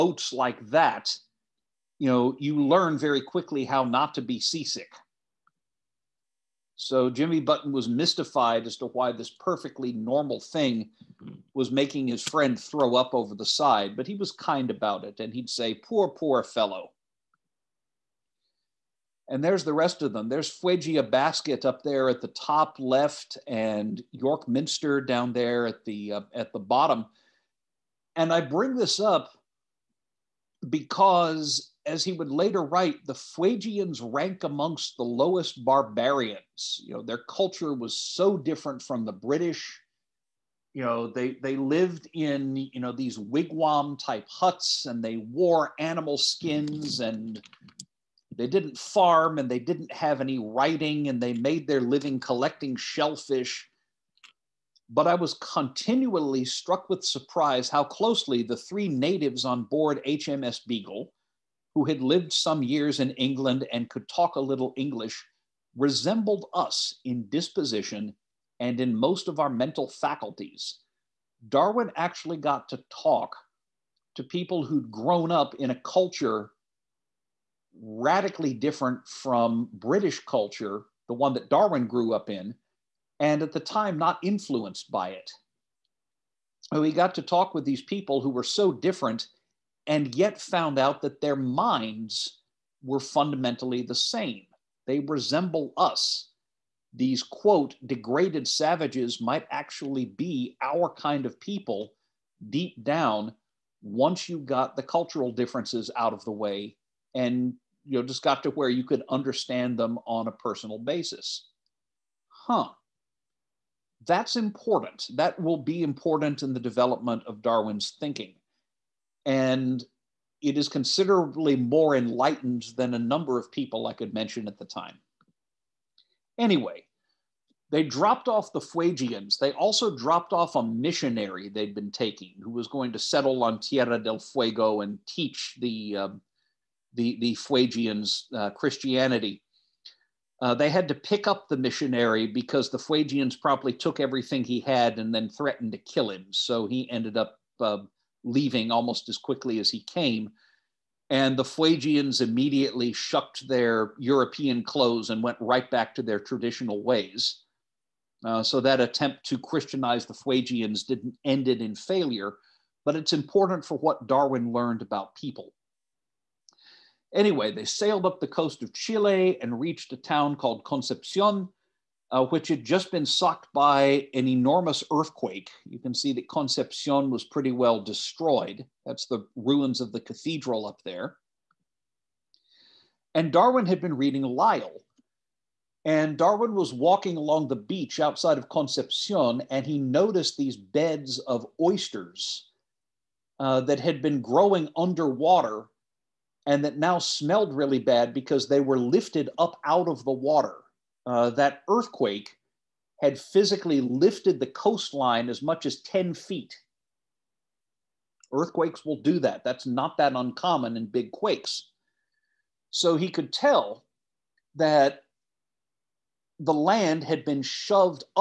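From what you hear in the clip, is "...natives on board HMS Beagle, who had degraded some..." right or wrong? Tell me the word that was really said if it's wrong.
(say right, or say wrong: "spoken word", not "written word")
wrong: "lived", not "degraded".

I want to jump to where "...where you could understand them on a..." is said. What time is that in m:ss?
1:48.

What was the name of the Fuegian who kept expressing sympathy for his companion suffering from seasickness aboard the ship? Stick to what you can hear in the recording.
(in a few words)
Jimmy Button.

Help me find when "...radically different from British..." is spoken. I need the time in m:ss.
1:17.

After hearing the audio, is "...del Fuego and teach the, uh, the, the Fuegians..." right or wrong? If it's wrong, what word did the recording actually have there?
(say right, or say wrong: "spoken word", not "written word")
right.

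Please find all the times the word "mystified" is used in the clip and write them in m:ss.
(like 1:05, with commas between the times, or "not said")
0:07.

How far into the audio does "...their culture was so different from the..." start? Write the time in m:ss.
0:37.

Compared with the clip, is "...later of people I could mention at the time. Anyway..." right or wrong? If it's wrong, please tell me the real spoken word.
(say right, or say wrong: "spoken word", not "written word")
wrong: "number", not "later".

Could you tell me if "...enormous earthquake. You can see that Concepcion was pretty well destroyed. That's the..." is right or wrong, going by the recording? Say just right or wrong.
right.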